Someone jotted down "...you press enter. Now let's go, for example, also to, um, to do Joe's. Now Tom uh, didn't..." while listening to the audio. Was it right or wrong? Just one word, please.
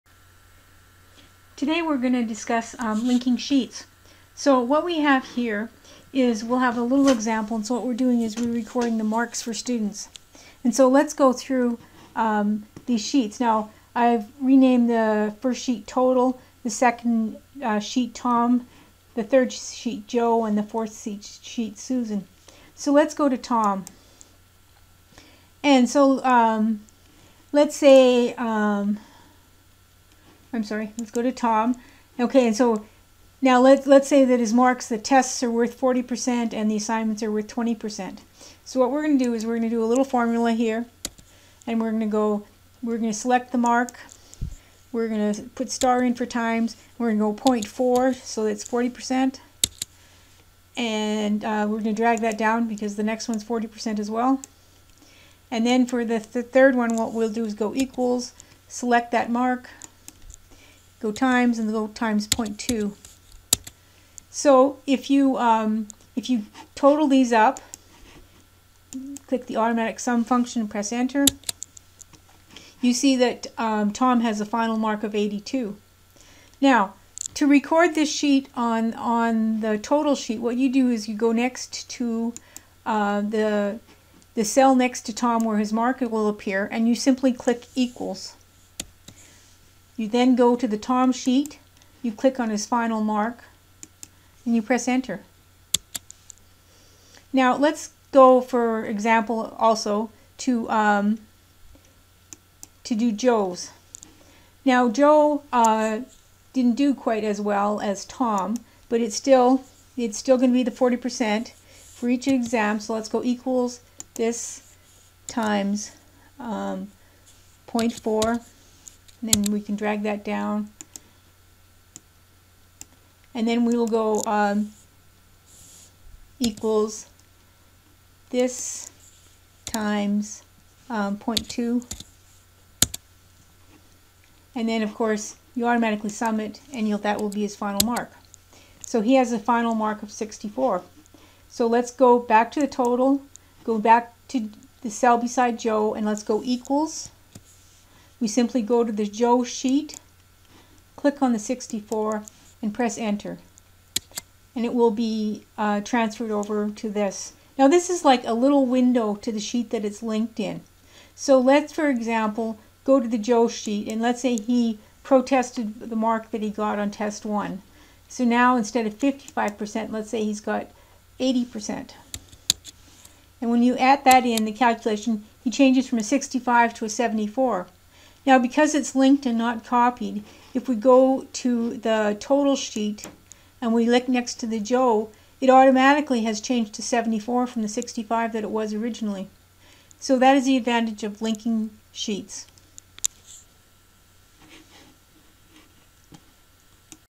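wrong.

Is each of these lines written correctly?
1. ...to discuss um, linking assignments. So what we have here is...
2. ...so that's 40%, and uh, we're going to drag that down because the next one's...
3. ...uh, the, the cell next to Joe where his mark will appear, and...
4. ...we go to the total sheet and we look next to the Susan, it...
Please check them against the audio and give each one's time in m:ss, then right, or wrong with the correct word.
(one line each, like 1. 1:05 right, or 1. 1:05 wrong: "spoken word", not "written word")
1. 0:02 wrong: "sheets", not "assignments"
2. 0:48 right
3. 1:22 wrong: "Tom", not "Joe"
4. 3:00 wrong: "Joe", not "Susan".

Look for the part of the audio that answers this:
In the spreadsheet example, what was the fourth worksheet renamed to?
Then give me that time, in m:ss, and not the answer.
0:21.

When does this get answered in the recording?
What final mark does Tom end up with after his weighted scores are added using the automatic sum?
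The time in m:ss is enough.
1:15.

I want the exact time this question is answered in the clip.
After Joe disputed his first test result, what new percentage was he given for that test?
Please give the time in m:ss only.
2:51.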